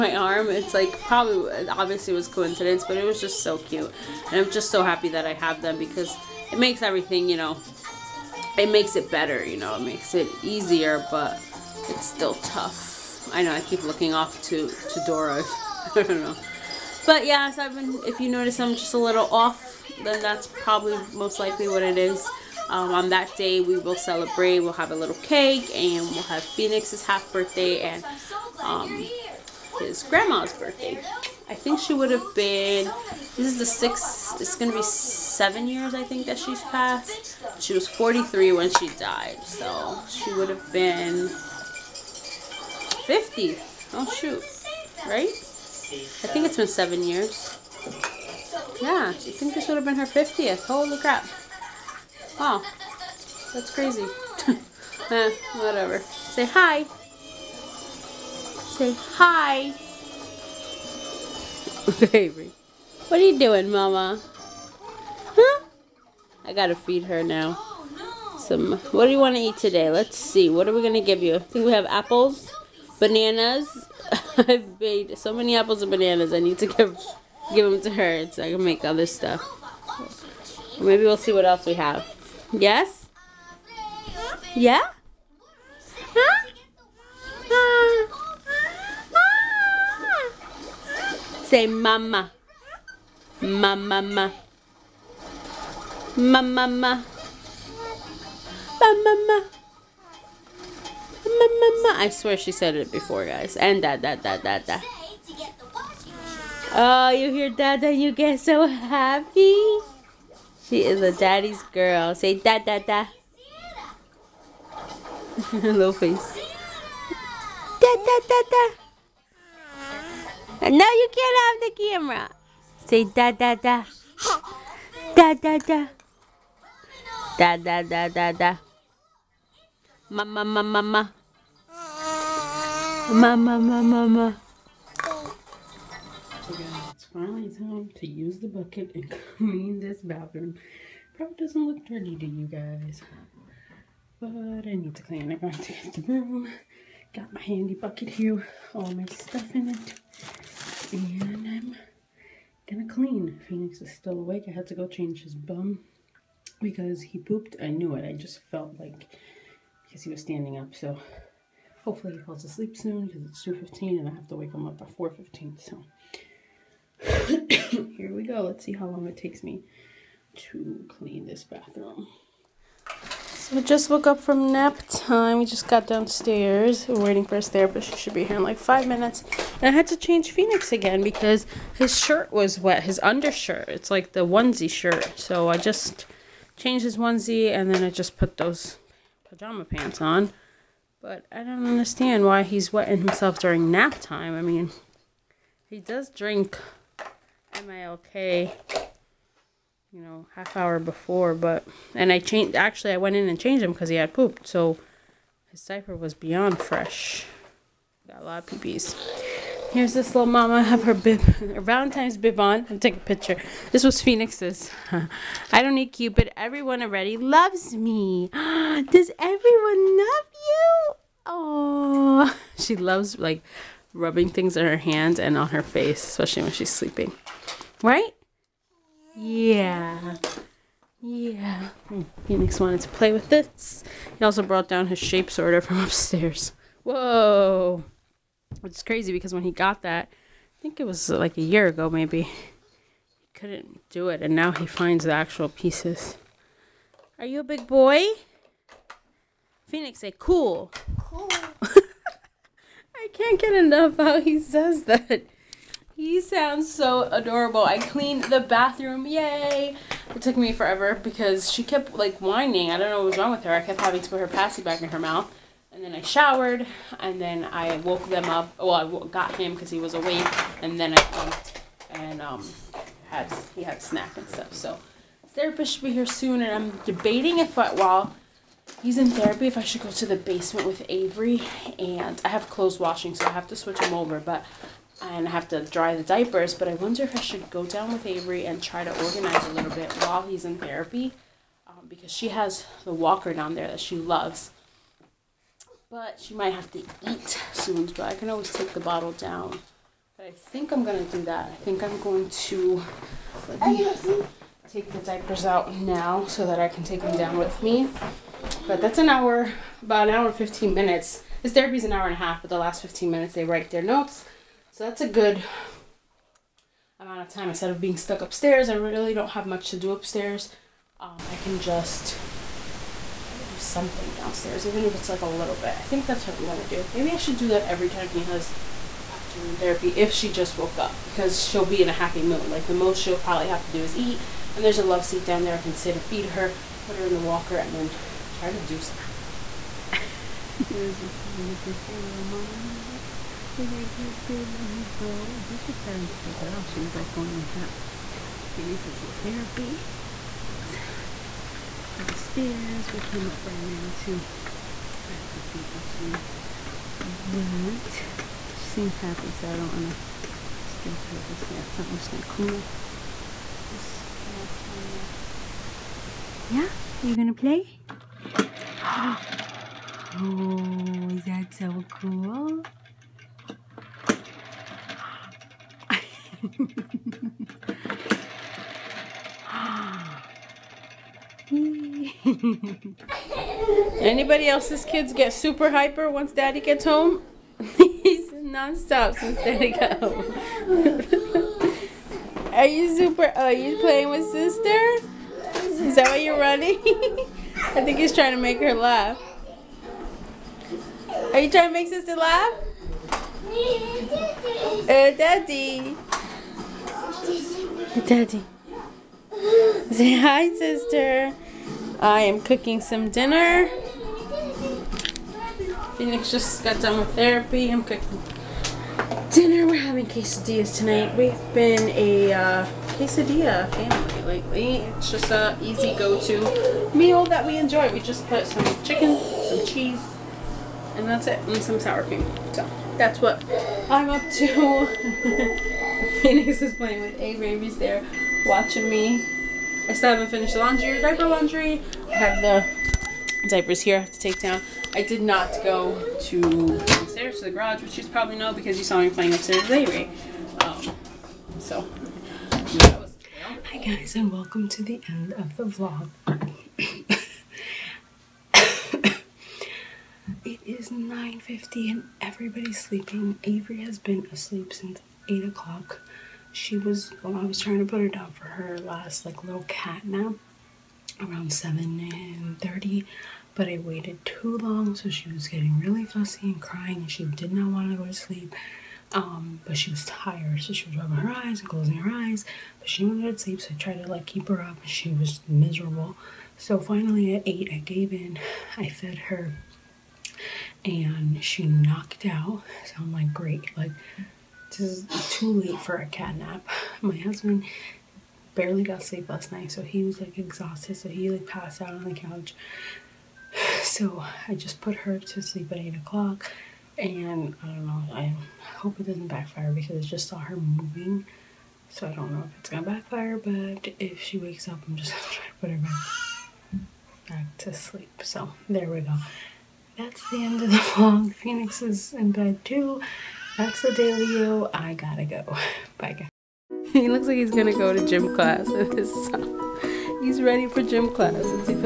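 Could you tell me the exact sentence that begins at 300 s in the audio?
But I think I'm gonna do that.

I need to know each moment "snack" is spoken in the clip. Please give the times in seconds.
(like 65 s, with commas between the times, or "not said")
273 s.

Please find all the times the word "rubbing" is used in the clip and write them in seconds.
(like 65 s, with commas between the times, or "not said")
223 s, 480 s.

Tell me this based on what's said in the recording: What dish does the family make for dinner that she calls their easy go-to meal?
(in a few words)
quesadillas.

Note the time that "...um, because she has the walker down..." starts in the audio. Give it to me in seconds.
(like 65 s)
291 s.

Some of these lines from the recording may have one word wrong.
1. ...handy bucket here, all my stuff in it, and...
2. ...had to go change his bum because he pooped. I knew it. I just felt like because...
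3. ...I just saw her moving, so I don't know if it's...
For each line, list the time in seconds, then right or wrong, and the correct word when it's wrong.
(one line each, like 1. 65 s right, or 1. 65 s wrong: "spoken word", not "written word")
1. 147 s right
2. 154 s right
3. 510 s right.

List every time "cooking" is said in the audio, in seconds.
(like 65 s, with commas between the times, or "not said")
412 s, 417 s.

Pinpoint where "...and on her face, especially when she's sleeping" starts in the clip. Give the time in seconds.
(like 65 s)
225 s.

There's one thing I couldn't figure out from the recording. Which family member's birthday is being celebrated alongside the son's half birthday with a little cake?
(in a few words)
his grandma's.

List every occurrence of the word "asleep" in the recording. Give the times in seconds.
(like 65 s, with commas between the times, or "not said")
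162 s, 464 s.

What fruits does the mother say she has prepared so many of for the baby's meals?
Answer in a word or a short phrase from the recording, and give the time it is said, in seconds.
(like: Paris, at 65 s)
apples and bananas, at 75 s.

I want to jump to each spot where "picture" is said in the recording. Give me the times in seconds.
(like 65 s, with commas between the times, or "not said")
213 s, 341 s.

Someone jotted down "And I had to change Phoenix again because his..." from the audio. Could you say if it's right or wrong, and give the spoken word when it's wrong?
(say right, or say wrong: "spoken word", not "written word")
right.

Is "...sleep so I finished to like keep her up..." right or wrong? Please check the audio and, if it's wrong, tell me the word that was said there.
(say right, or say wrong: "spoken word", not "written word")
wrong: "tried", not "finished".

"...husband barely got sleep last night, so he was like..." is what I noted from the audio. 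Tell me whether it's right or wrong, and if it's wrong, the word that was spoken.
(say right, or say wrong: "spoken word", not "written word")
right.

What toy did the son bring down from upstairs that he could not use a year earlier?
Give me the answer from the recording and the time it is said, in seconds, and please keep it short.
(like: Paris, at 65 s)
shape sorter, at 234 s.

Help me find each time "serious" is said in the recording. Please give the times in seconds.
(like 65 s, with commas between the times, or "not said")
not said.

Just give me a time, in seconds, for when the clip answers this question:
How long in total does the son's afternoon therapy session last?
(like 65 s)
311 s.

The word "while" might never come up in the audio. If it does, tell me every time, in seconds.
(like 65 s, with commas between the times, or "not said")
277 s, 290 s.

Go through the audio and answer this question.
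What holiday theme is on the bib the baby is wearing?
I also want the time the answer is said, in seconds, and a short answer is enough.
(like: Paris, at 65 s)
Valentine's, at 211 s.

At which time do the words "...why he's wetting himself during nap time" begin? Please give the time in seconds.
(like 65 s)
192 s.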